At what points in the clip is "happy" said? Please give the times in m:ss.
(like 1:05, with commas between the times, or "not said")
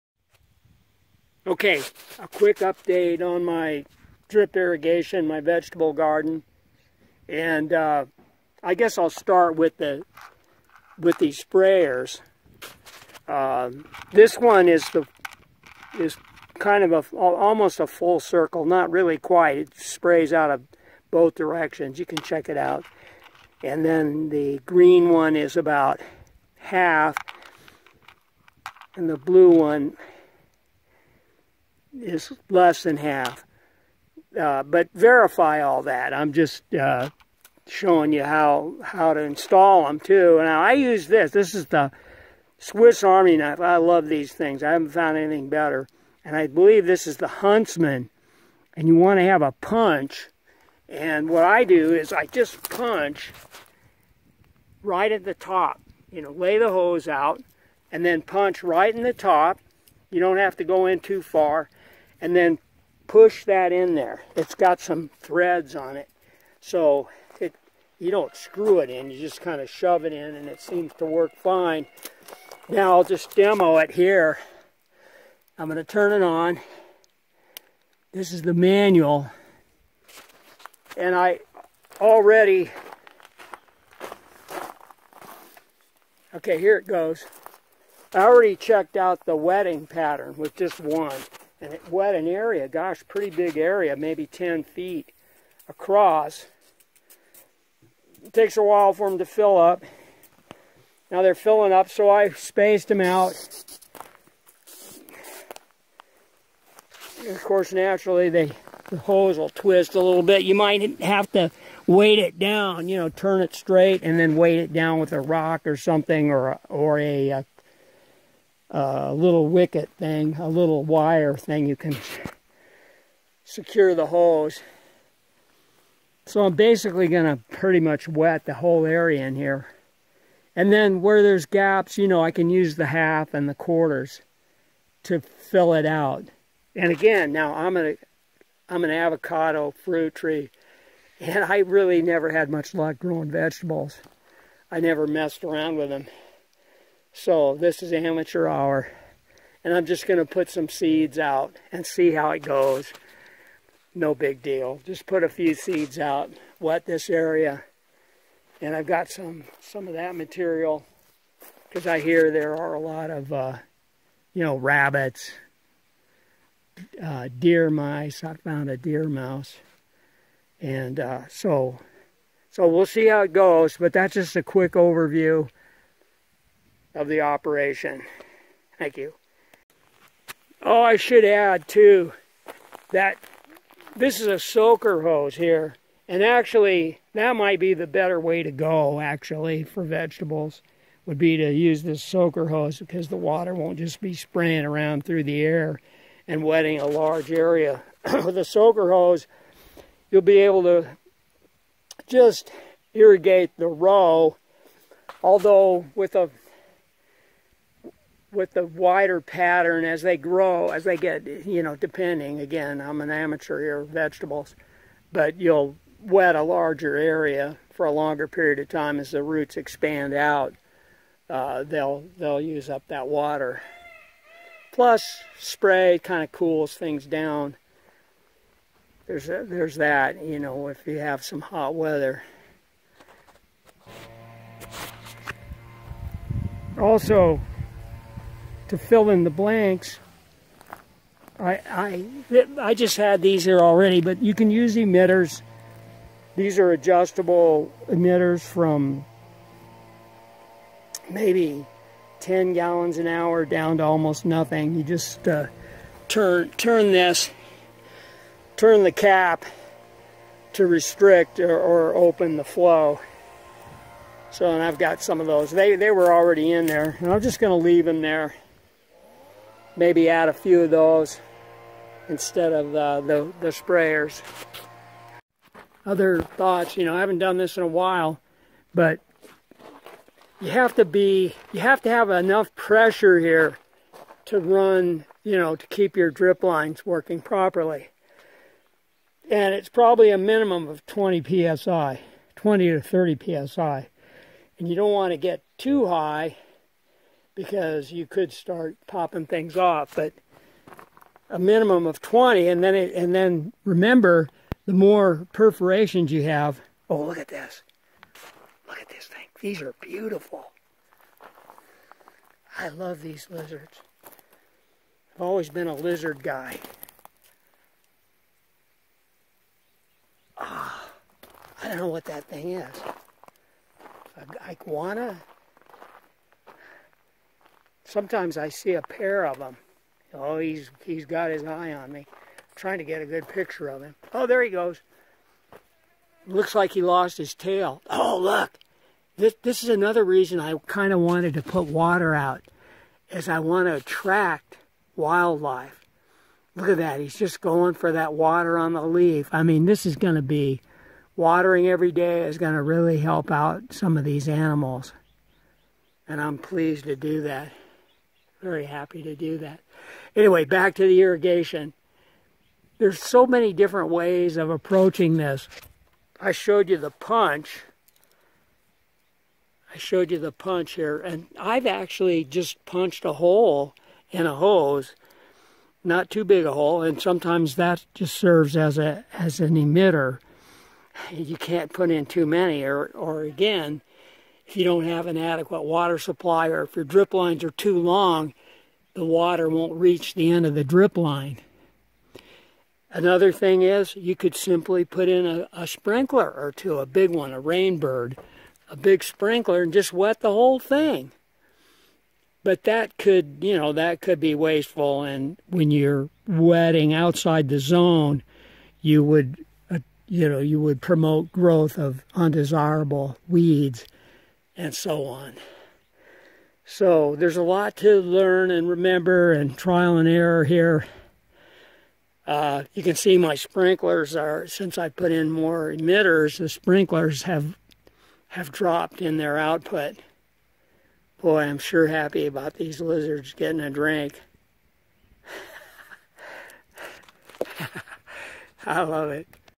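5:58, 7:11.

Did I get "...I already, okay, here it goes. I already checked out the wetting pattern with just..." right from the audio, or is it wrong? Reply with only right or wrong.
right.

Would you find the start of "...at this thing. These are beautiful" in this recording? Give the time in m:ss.
5:08.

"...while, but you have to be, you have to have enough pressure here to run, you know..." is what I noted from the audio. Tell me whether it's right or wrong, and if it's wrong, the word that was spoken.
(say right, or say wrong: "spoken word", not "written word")
right.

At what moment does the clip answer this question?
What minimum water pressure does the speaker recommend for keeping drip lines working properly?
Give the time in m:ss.
4:50.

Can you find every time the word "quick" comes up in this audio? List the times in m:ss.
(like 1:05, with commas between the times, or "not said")
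0:02, 2:54.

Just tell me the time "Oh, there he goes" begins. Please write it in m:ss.
5:34.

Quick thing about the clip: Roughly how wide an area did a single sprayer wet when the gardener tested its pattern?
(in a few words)
10 feet.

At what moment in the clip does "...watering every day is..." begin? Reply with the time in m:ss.
5:51.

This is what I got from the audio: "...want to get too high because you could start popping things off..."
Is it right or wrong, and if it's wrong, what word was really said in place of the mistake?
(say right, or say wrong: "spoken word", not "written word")
right.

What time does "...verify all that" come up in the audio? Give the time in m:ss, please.
0:34.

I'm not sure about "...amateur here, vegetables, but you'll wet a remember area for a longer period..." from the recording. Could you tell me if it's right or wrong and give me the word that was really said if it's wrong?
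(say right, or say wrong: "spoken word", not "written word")
wrong: "larger", not "remember".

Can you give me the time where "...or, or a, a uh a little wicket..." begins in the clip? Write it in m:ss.
1:56.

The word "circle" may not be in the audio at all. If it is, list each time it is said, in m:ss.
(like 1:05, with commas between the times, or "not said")
0:18.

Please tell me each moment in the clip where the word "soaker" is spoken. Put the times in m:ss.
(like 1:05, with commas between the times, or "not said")
3:04, 3:12, 3:18.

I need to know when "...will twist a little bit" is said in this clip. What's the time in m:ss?
1:49.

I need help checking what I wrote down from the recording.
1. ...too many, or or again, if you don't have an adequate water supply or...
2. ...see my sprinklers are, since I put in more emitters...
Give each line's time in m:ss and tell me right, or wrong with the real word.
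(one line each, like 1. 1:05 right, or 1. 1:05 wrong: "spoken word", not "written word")
1. 6:22 right
2. 7:02 right.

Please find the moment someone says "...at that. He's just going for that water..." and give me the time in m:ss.
5:46.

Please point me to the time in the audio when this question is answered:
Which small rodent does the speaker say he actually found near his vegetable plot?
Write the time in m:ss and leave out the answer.
2:48.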